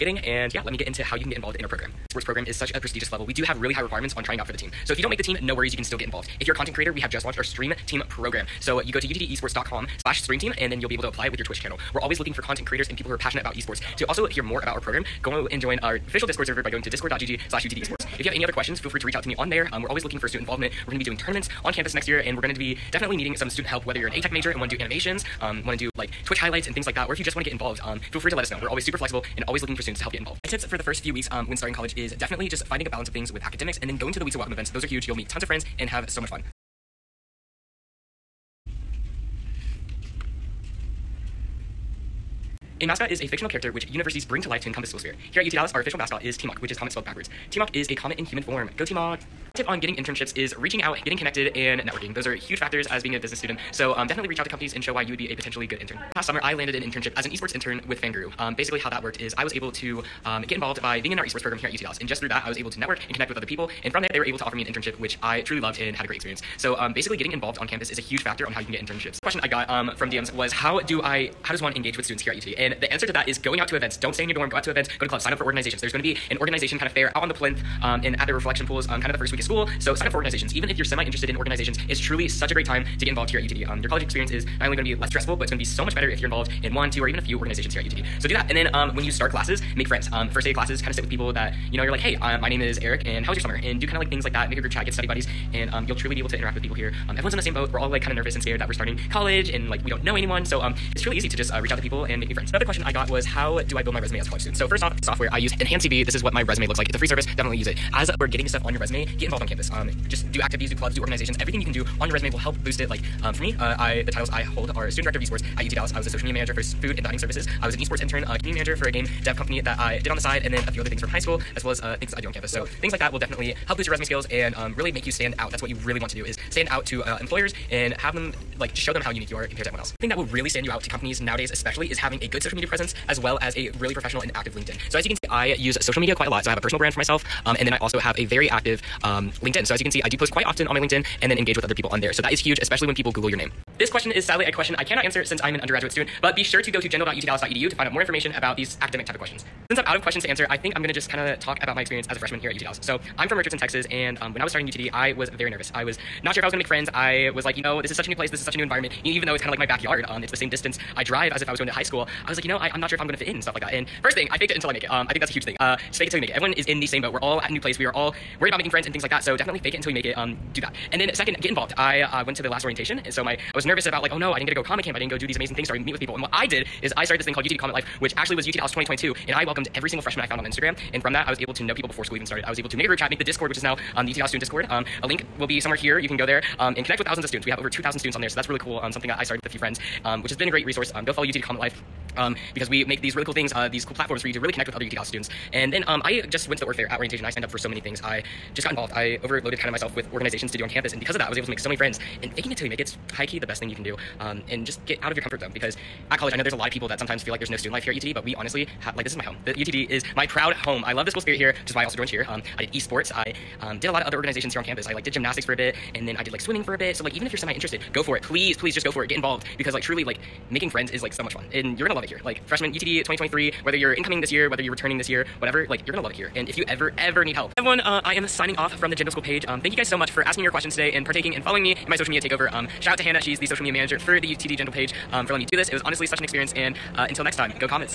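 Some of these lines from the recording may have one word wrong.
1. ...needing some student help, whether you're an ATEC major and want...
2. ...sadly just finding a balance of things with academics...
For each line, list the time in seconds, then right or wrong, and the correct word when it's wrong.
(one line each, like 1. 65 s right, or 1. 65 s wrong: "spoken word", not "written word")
1. 23 s right
2. 32 s wrong: "definitely", not "sadly".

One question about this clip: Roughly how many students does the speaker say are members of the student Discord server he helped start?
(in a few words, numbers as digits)
2,000.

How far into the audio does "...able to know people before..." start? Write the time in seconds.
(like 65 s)
181 s.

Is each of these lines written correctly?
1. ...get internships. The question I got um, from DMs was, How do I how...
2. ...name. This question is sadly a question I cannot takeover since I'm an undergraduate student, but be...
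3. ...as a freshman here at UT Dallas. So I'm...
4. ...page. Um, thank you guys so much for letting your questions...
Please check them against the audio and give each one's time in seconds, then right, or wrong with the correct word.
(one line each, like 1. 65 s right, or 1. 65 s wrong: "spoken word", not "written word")
1. 68 s right
2. 143 s wrong: "answer", not "takeover"
3. 152 s right
4. 229 s wrong: "asking", not "letting".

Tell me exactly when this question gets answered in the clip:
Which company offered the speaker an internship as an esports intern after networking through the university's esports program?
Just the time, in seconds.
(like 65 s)
58 s.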